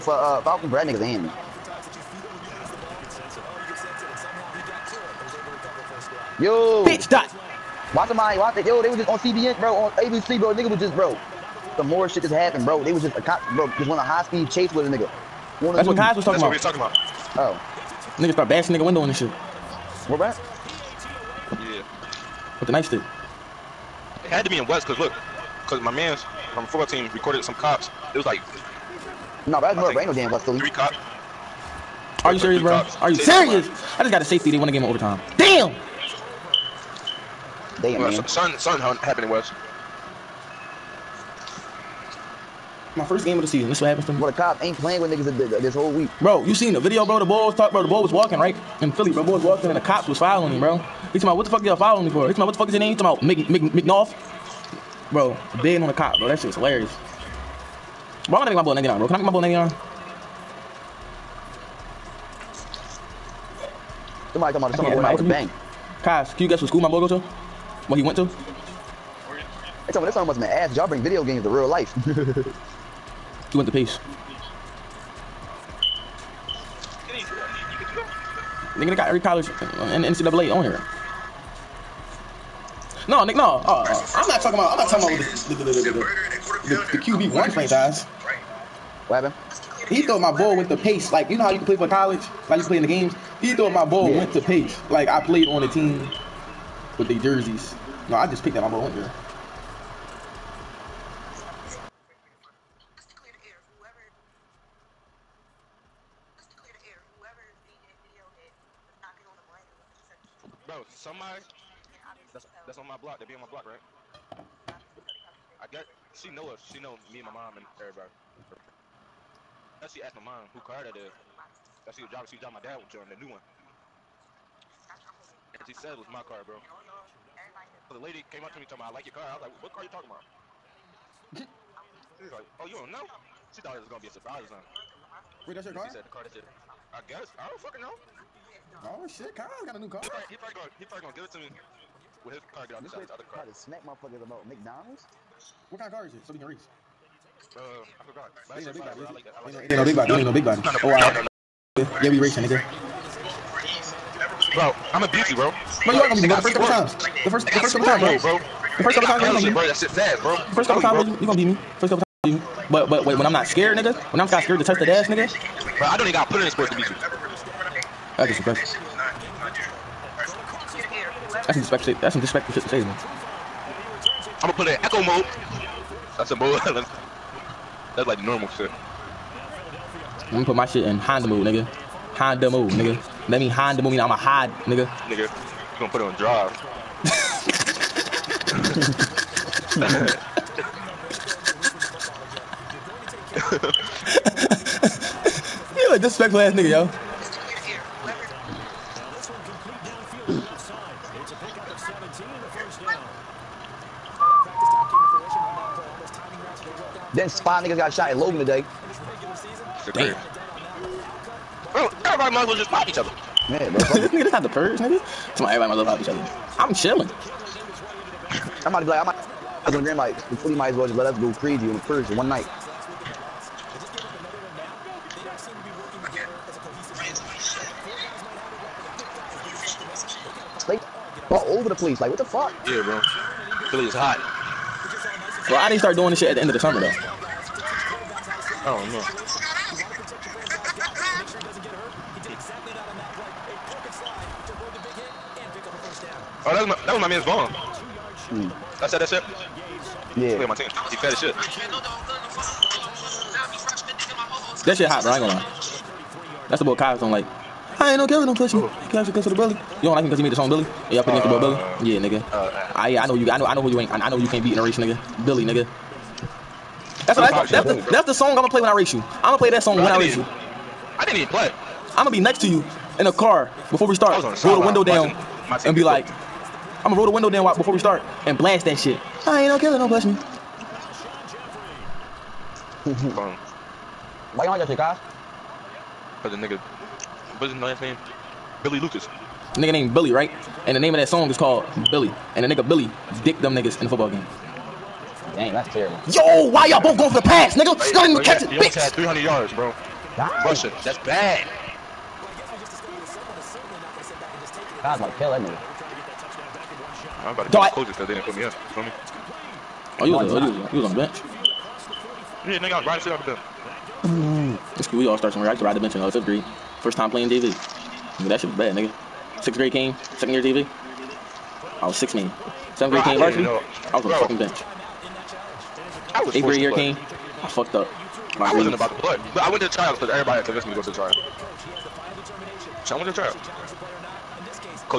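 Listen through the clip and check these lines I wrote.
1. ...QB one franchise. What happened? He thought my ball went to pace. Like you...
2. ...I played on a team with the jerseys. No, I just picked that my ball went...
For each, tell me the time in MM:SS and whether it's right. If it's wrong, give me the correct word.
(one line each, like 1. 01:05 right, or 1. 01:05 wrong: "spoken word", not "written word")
1. 01:27 right
2. 01:35 right.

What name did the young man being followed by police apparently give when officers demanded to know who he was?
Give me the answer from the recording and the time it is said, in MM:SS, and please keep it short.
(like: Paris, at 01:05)
McNoff, at 00:53.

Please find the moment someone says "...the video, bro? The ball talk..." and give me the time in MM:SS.
00:46.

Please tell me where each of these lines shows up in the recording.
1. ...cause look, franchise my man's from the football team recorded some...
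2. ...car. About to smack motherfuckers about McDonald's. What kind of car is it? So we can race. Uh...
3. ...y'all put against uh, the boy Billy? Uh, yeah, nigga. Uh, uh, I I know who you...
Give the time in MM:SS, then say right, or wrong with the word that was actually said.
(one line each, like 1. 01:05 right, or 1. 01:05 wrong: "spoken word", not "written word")
1. 00:24 wrong: "cause", not "franchise"
2. 02:23 right
3. 04:20 right.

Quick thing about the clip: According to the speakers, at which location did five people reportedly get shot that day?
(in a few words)
Logan.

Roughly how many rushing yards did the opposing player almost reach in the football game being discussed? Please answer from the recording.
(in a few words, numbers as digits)
300.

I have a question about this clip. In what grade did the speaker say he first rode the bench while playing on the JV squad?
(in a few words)
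Fifth grade.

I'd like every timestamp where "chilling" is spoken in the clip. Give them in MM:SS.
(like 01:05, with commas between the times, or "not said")
03:36.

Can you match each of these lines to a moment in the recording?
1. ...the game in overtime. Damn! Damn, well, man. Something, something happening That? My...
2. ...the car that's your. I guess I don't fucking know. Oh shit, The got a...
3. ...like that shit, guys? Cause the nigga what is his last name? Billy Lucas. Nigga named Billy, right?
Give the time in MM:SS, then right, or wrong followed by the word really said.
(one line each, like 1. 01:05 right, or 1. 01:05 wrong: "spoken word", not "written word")
1. 00:34 wrong: "West", not "That"
2. 02:16 wrong: "Kyle", not "The"
3. 04:44 right.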